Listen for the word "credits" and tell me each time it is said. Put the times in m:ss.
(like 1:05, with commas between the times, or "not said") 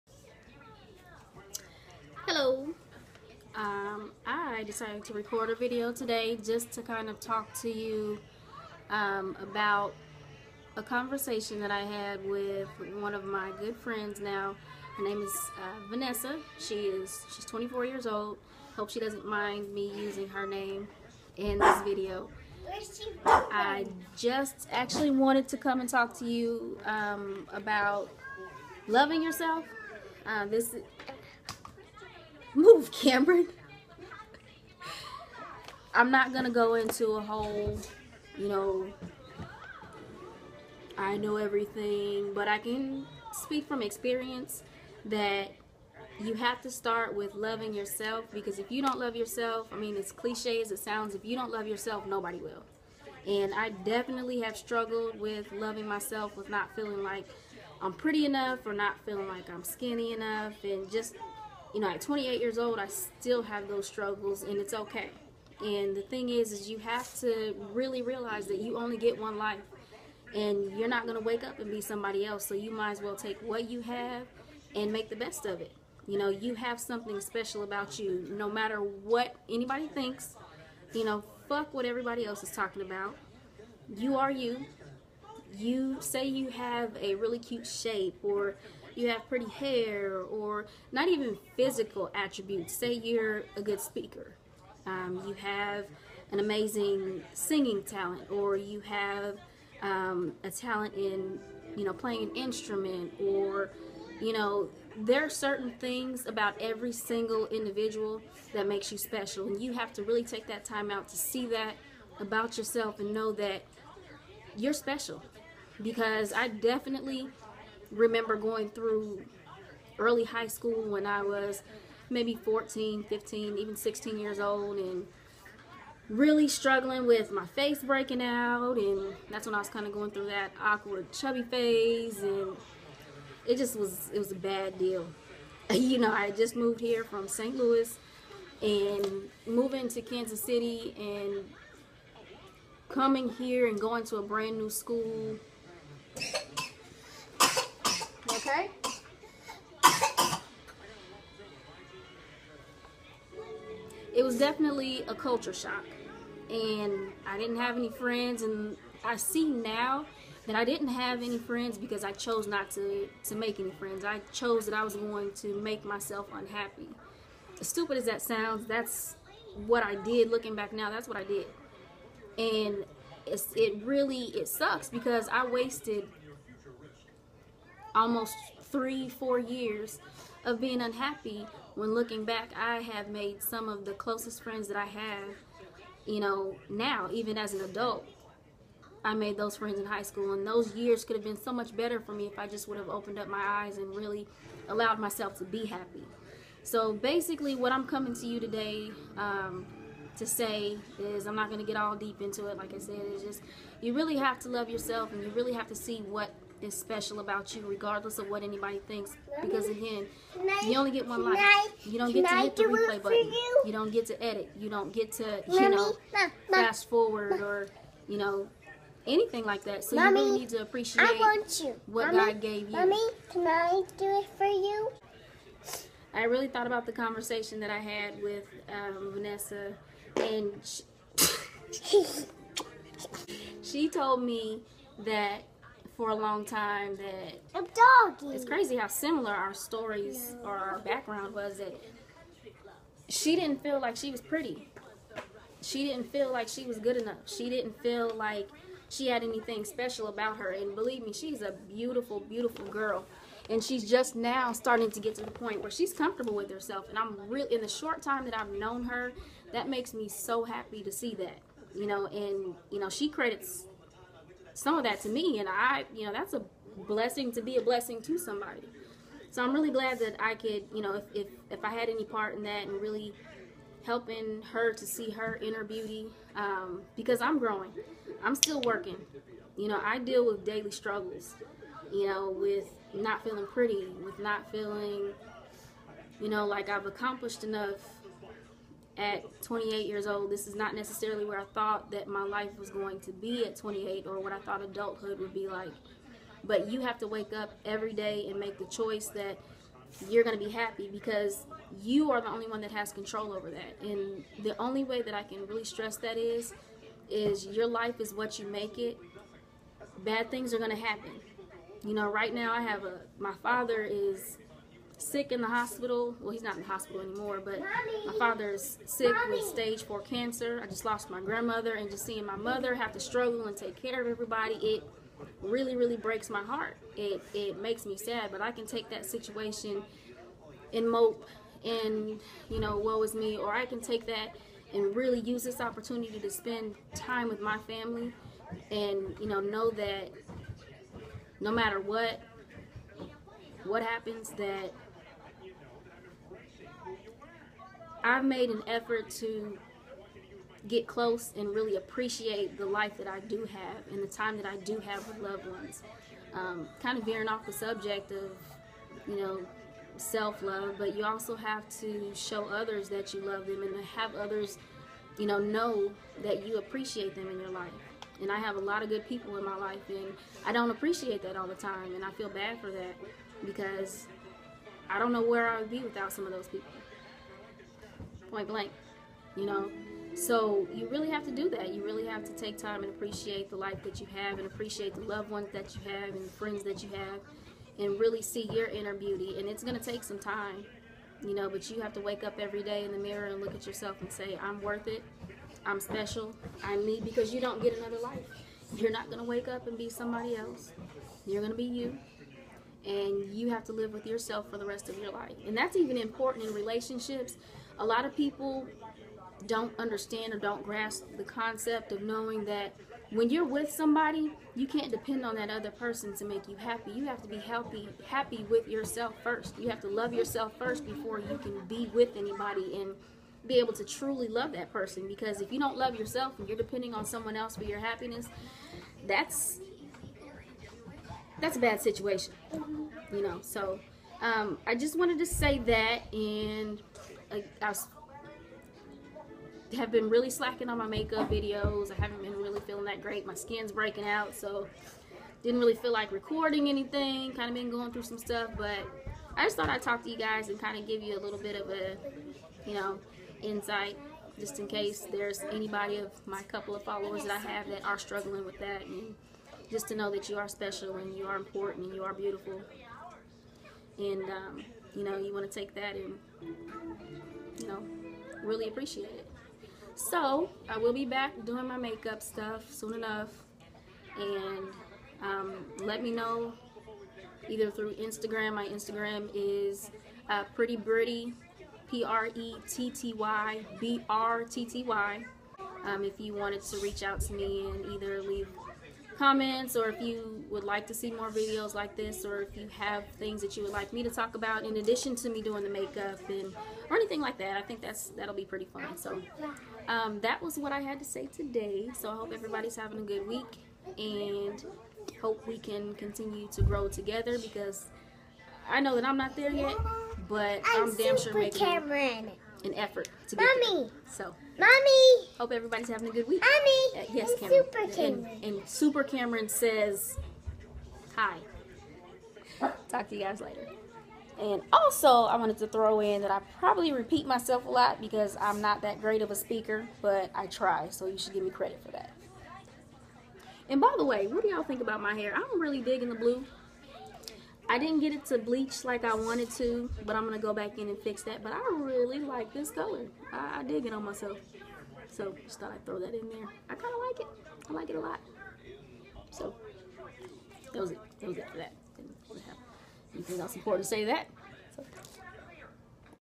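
4:23, 8:51.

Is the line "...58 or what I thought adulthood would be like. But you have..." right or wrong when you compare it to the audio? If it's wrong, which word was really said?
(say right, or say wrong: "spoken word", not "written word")
wrong: "28", not "58".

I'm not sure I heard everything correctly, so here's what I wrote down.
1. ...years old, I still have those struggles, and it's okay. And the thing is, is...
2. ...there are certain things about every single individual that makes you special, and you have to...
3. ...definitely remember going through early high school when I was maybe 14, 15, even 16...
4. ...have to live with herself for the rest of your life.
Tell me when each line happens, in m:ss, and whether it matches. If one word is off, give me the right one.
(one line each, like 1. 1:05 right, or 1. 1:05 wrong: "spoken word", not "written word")
1. 1:02 right
2. 1:44 right
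3. 1:56 right
4. 6:43 wrong: "yourself", not "herself".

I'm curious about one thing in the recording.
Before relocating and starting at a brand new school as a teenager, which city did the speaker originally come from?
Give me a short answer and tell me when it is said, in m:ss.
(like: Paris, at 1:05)
St. Louis, at 2:17.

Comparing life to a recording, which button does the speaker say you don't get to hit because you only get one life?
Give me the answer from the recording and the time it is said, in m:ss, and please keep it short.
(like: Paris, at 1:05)
The replay button, at 3:32.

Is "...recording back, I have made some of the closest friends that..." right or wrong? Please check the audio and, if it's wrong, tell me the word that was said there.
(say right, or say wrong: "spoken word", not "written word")
wrong: "looking", not "recording".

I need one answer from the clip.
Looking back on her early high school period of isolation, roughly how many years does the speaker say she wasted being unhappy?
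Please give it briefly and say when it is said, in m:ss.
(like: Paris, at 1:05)
3 or 4 years, at 2:58.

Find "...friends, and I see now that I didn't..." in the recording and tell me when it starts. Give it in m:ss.
2:37.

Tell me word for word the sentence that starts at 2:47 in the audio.
As stupid as that sounds, that's what I did looking back now.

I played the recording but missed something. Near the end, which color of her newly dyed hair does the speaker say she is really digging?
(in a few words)
Blue.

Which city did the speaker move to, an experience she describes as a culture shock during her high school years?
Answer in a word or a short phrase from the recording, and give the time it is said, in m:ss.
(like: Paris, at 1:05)
Kansas City, at 2:20.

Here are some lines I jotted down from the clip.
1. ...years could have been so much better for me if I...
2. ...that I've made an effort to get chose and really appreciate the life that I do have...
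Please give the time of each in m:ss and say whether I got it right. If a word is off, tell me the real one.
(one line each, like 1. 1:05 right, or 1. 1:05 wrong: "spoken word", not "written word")
1. 3:10 right
2. 5:44 wrong: "close", not "chose".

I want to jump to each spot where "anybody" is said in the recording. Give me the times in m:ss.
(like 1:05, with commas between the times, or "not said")
1:19, 3:28, 7:02, 7:35.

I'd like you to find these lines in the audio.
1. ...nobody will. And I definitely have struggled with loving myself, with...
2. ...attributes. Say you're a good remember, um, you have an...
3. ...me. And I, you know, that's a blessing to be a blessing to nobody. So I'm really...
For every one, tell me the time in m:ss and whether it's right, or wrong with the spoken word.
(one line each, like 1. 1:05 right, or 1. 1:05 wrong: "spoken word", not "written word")
1. 0:52 right
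2. 1:32 wrong: "speaker", not "remember"
3. 4:25 wrong: "somebody", not "nobody".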